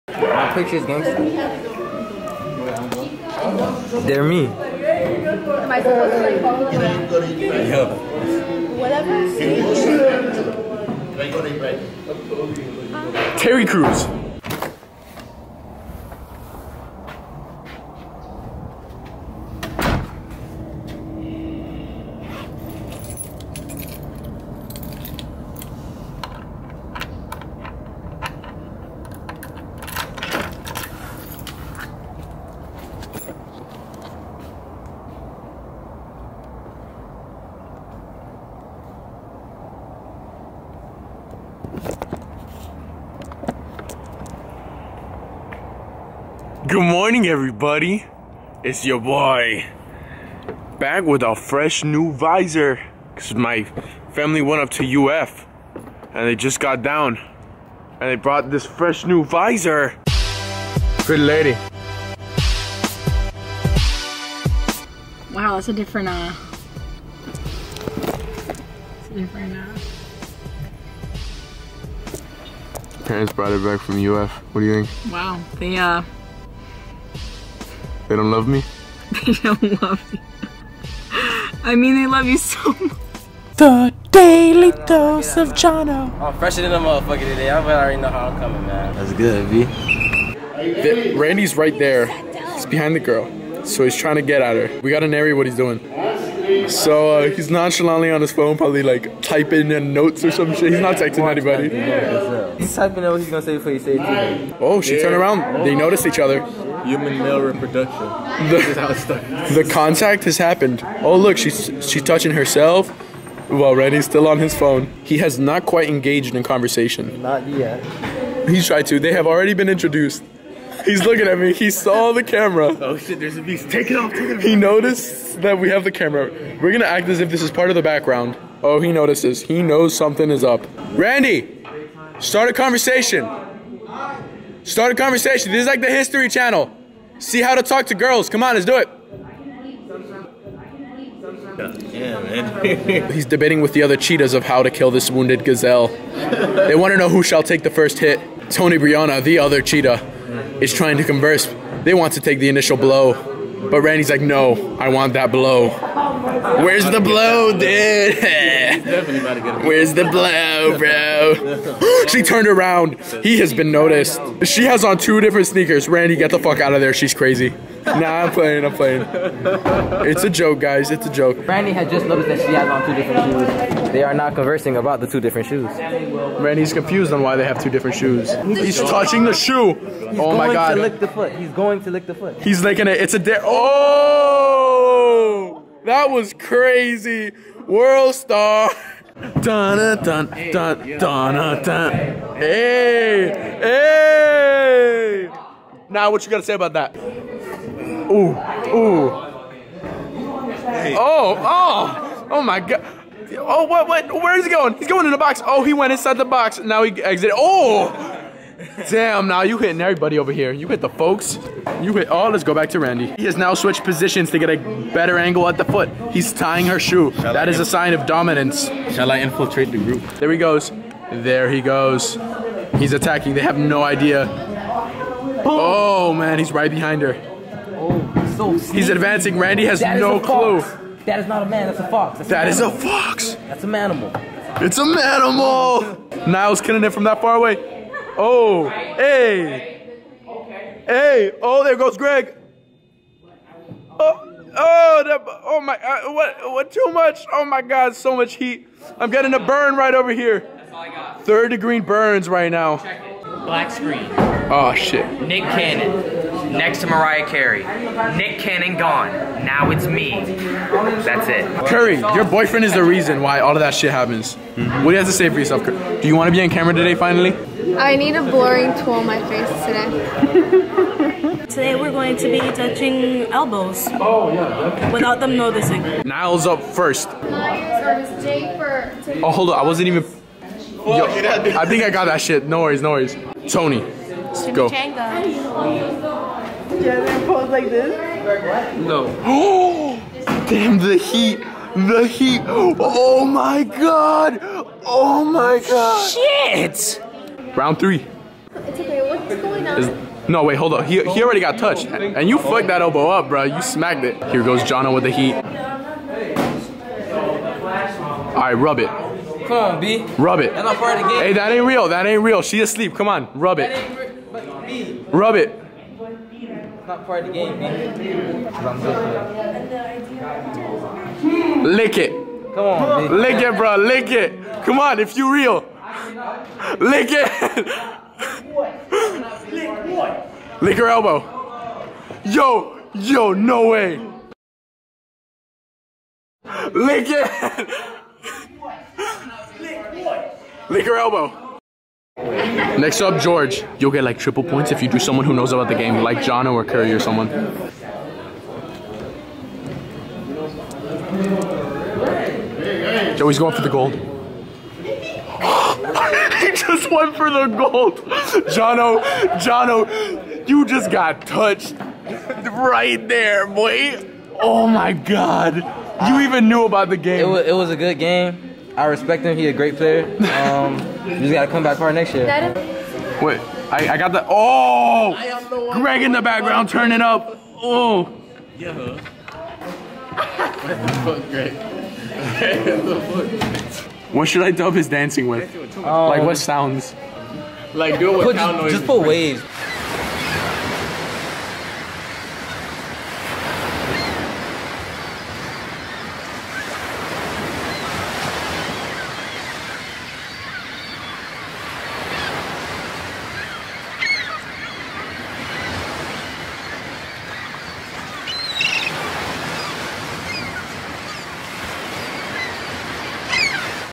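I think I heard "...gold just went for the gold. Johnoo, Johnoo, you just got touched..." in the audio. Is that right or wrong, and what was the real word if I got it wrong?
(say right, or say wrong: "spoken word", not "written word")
right.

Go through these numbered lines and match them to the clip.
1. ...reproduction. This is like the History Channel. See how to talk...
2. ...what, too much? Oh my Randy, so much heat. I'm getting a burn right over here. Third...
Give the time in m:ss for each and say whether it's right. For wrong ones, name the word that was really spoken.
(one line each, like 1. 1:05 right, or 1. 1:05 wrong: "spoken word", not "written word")
1. 2:14 wrong: "conversation", not "reproduction"
2. 4:06 wrong: "God", not "Randy".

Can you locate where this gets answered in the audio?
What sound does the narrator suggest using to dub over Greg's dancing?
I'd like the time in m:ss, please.
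6:29.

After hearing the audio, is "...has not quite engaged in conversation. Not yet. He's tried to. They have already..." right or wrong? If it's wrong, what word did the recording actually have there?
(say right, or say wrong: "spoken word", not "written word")
right.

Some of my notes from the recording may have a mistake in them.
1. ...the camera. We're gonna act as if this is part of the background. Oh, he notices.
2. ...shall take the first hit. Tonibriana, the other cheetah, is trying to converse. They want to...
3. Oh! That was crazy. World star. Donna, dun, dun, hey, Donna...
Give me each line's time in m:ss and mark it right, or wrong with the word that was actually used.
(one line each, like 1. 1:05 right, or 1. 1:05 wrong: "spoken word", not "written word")
1. 2:05 right
2. 2:27 right
3. 3:03 right.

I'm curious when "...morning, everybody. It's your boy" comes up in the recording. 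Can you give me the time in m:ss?
0:46.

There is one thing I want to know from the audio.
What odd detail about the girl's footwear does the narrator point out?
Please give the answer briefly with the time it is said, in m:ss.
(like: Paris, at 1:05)
Two different sneakers, at 2:44.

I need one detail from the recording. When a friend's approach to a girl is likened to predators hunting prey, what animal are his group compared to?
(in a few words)
Cheetahs.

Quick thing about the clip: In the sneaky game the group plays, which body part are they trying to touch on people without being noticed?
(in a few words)
Elbows.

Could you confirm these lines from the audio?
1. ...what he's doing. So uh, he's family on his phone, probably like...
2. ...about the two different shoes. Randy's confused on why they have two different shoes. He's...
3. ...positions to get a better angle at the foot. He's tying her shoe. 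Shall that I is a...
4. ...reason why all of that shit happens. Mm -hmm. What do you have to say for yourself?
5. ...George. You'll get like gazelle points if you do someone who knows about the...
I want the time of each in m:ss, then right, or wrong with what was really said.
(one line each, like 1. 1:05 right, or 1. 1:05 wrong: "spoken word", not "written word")
1. 1:35 wrong: "nonchalantly", not "family"
2. 2:54 right
3. 3:33 right
4. 4:22 right
5. 5:43 wrong: "triple", not "gazelle".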